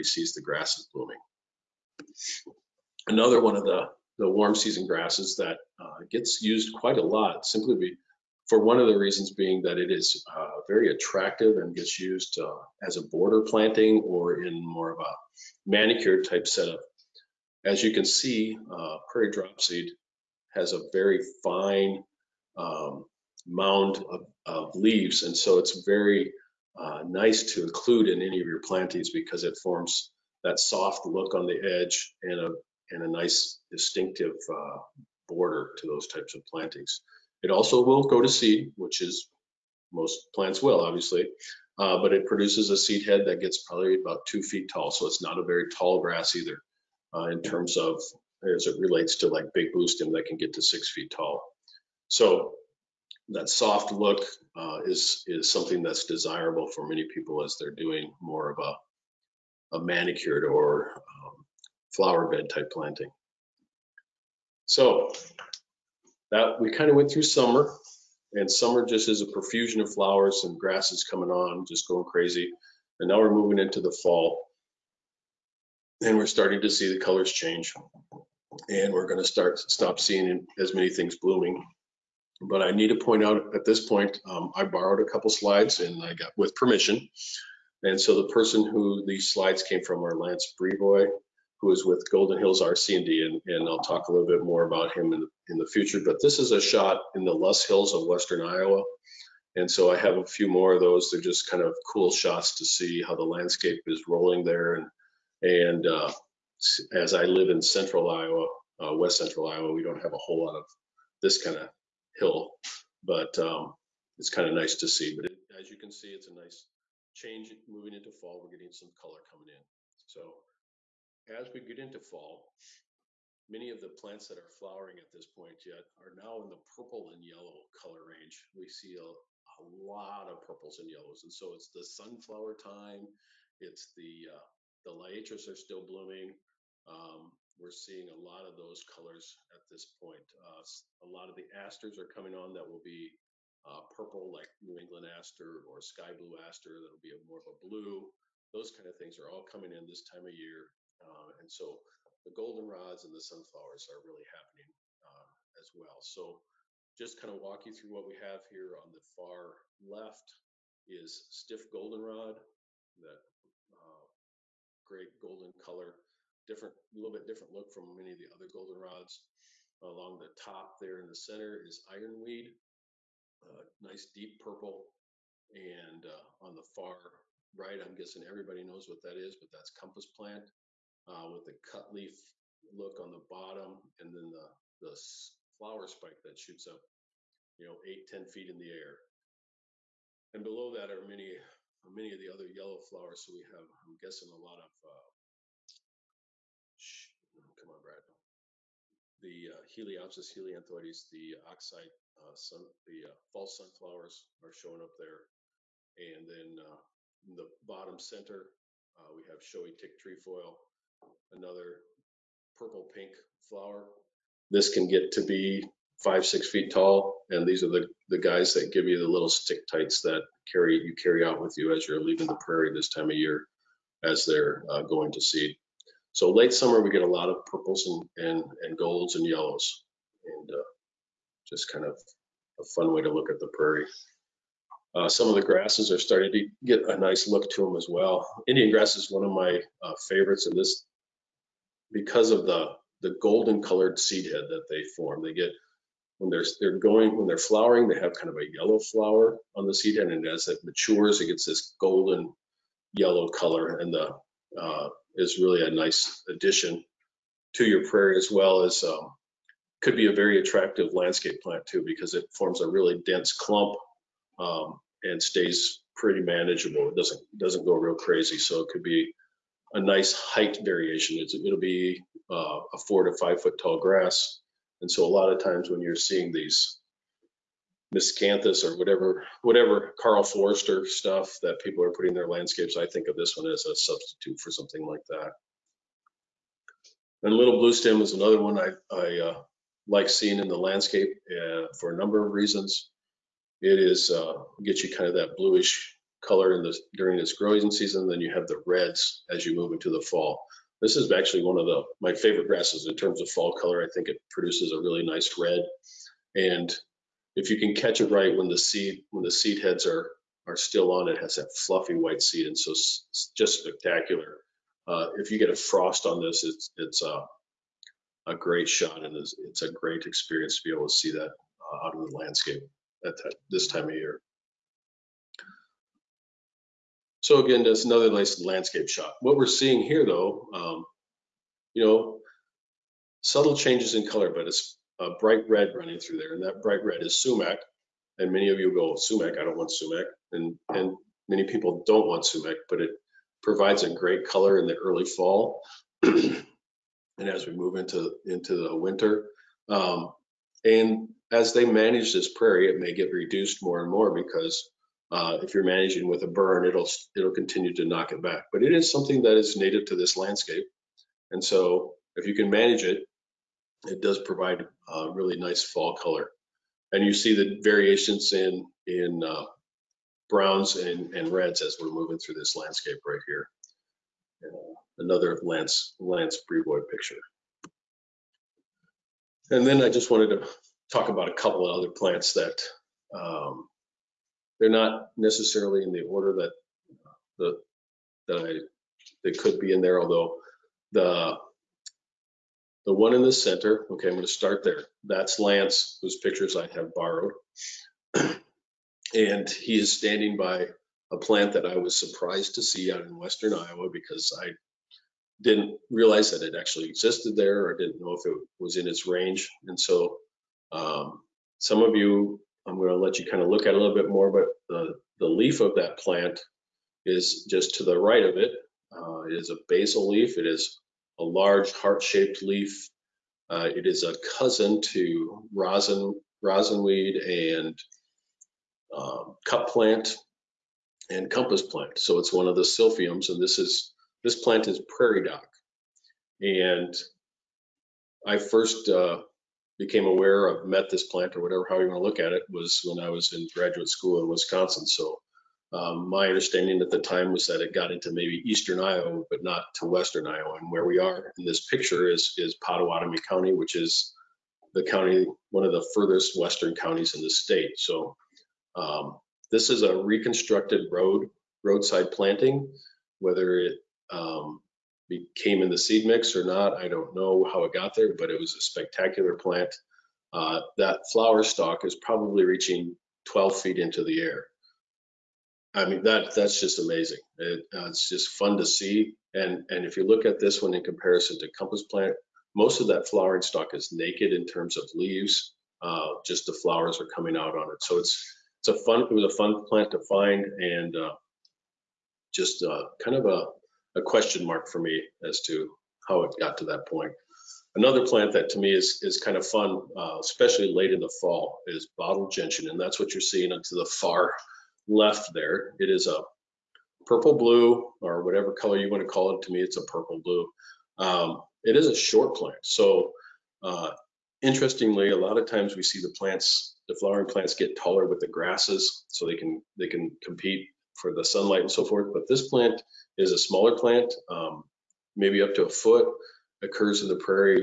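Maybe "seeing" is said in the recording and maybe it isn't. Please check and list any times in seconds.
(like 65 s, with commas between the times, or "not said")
80 s, 137 s, 275 s, 290 s, 329 s, 503 s.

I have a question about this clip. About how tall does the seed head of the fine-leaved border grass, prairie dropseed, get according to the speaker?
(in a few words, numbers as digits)
2 feet.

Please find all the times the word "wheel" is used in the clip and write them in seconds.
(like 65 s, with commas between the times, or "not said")
not said.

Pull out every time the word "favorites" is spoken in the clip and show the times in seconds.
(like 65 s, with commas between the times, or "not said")
240 s, 302 s.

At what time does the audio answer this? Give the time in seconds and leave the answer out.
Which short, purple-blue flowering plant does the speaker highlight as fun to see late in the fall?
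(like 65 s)
501 s.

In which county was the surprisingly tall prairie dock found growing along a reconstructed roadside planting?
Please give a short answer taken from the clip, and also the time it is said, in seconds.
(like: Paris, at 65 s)
Pottawattamie County, at 452 s.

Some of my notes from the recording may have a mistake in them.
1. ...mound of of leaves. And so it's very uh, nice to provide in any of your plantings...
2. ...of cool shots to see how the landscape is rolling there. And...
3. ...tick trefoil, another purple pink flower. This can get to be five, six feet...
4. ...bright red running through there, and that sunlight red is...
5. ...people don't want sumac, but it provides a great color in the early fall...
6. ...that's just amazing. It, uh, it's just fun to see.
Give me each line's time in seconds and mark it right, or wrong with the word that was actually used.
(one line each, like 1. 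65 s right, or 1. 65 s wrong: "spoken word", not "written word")
1. 23 s wrong: "include", not "provide"
2. 101 s right
3. 209 s right
4. 335 s wrong: "bright", not "sunlight"
5. 341 s right
6. 476 s right.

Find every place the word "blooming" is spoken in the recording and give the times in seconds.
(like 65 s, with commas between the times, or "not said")
0 s, 81 s, 135 s.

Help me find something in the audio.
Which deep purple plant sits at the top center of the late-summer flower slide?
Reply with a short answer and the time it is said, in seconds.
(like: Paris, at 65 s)
Ironweed, at 171 s.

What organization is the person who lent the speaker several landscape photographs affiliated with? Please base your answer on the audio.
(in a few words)
Golden Hills RC&D.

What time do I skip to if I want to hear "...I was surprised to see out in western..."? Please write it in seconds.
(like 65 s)
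401 s.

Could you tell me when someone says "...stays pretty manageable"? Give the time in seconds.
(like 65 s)
265 s.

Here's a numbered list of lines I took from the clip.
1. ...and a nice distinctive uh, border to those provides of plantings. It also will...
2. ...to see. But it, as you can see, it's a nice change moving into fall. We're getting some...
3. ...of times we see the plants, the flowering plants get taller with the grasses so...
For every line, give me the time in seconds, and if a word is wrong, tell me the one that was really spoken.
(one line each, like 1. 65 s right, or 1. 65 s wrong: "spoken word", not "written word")
1. 32 s wrong: "types", not "provides"
2. 114 s right
3. 515 s right.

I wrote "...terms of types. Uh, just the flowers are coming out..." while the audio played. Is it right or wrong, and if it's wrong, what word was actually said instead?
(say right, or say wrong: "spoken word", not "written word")
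wrong: "leaves", not "types".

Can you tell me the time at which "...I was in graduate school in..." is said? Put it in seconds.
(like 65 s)
443 s.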